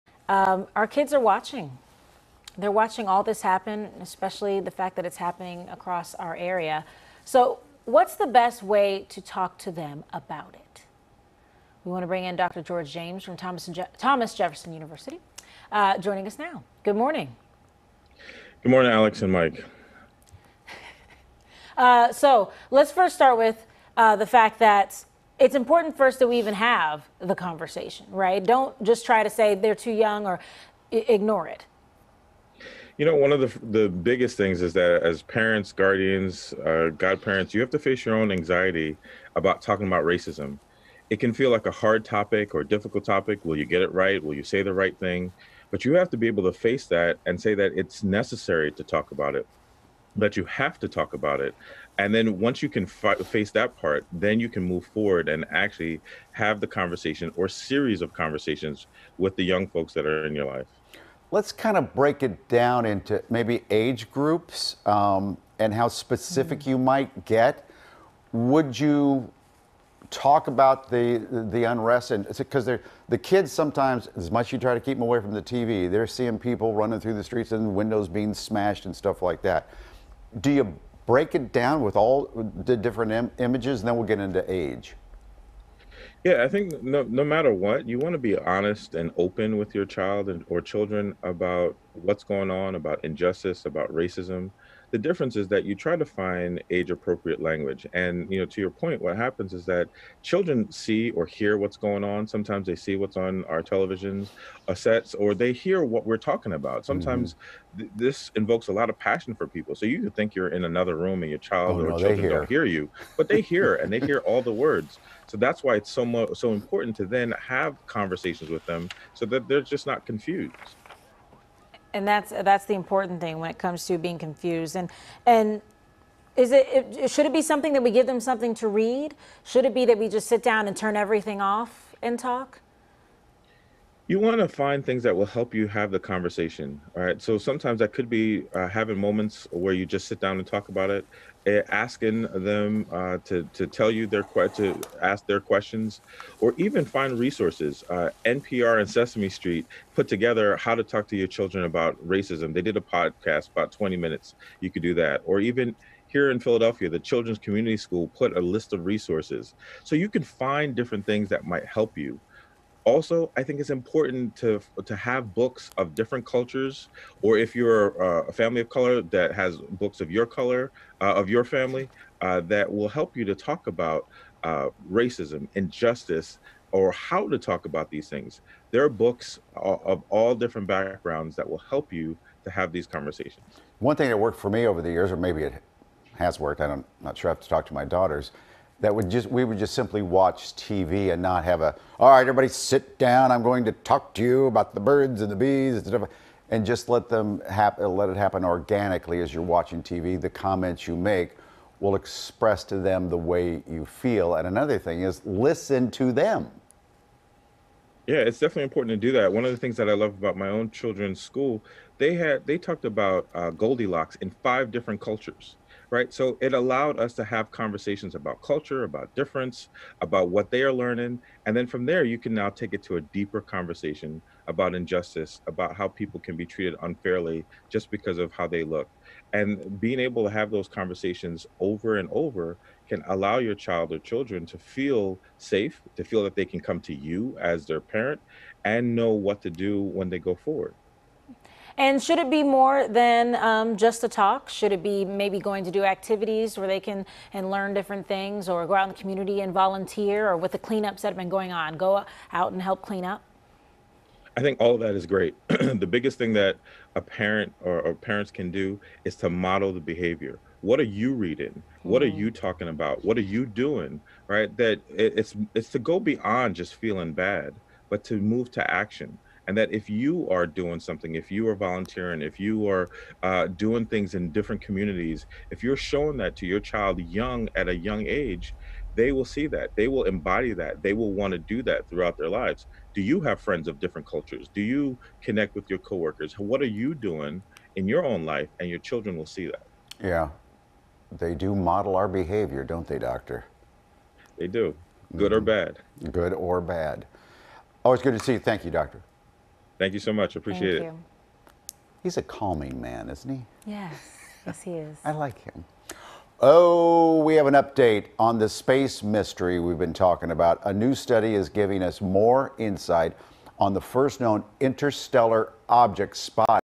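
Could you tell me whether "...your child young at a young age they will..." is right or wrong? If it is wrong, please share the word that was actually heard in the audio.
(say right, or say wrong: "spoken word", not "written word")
right.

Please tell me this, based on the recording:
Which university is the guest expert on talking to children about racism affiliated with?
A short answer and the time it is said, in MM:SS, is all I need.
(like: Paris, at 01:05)
Thomas Jefferson University, at 00:13.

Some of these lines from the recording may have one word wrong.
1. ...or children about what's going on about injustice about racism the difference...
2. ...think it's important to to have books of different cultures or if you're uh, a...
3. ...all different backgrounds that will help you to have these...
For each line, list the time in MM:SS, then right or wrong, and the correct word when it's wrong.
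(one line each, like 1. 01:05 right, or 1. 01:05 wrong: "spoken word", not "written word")
1. 01:30 right
2. 02:43 right
3. 03:00 right.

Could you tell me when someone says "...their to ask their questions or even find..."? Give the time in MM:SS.
02:24.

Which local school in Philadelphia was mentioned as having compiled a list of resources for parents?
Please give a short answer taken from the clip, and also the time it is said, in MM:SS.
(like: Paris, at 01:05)
Children's Community School, at 02:36.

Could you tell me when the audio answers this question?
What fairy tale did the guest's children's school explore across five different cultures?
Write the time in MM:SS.
03:33.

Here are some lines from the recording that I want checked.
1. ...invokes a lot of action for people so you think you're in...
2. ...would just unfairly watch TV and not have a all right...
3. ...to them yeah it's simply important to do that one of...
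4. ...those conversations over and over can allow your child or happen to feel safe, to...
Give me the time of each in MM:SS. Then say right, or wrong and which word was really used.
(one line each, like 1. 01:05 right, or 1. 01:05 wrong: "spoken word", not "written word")
1. 01:48 wrong: "passion", not "action"
2. 03:09 wrong: "simply", not "unfairly"
3. 03:25 wrong: "definitely", not "simply"
4. 03:50 wrong: "children", not "happen".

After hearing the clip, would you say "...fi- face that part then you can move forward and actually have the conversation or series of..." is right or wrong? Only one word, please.
right.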